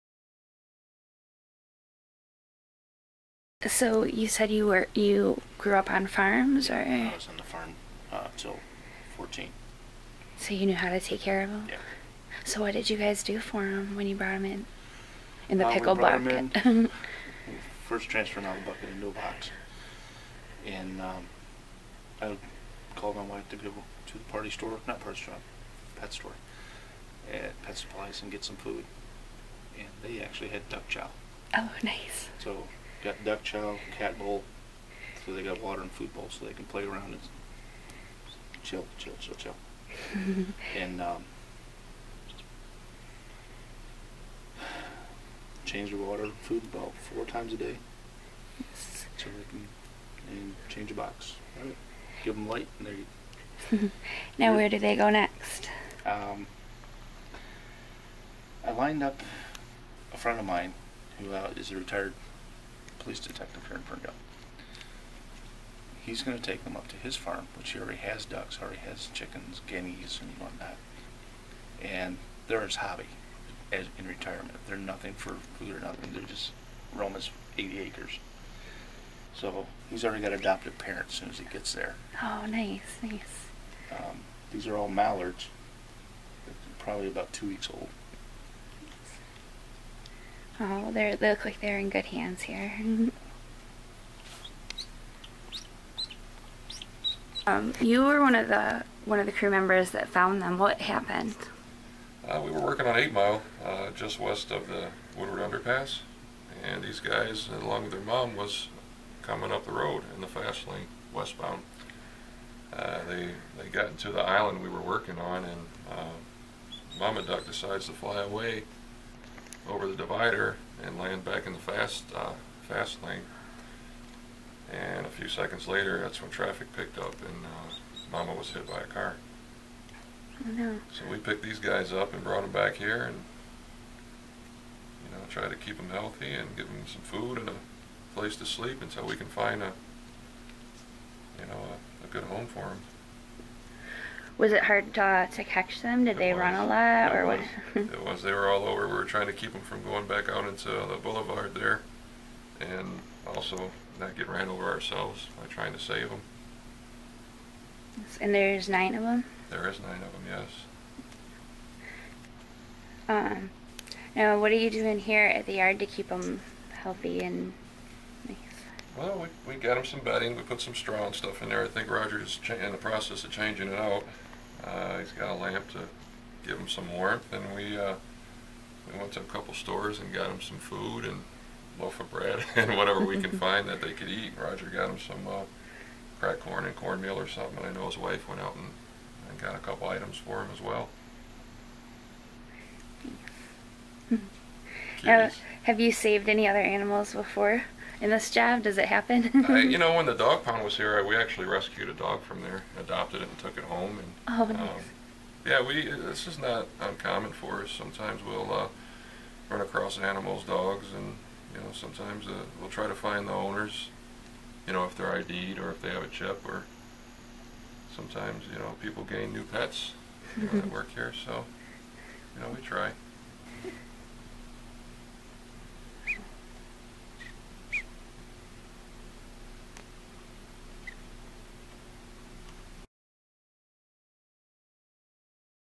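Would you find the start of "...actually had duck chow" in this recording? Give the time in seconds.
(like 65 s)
30 s.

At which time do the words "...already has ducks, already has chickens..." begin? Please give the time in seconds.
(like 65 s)
67 s.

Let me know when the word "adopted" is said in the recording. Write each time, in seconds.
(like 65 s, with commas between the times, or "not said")
80 s, 202 s.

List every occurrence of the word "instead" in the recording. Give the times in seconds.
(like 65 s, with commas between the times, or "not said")
not said.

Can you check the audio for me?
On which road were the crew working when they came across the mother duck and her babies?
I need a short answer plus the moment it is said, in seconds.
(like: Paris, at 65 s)
Eight Mile, at 102 s.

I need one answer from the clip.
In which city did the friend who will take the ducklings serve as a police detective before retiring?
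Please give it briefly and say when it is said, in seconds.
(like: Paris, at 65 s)
Ferndale, at 63 s.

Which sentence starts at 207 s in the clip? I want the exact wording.
Sometimes we'll uh, run across animals, dogs, and you know, sometimes uh, we'll try to find the owners.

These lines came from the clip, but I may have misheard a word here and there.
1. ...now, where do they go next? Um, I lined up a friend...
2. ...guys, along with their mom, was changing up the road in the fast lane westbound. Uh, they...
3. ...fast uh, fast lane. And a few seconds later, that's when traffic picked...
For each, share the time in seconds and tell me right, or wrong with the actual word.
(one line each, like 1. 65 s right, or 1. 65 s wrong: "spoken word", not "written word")
1. 54 s right
2. 106 s wrong: "coming", not "changing"
3. 121 s right.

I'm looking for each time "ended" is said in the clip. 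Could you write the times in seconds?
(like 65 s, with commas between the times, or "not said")
not said.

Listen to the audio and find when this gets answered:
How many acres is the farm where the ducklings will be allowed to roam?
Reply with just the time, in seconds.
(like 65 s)
77 s.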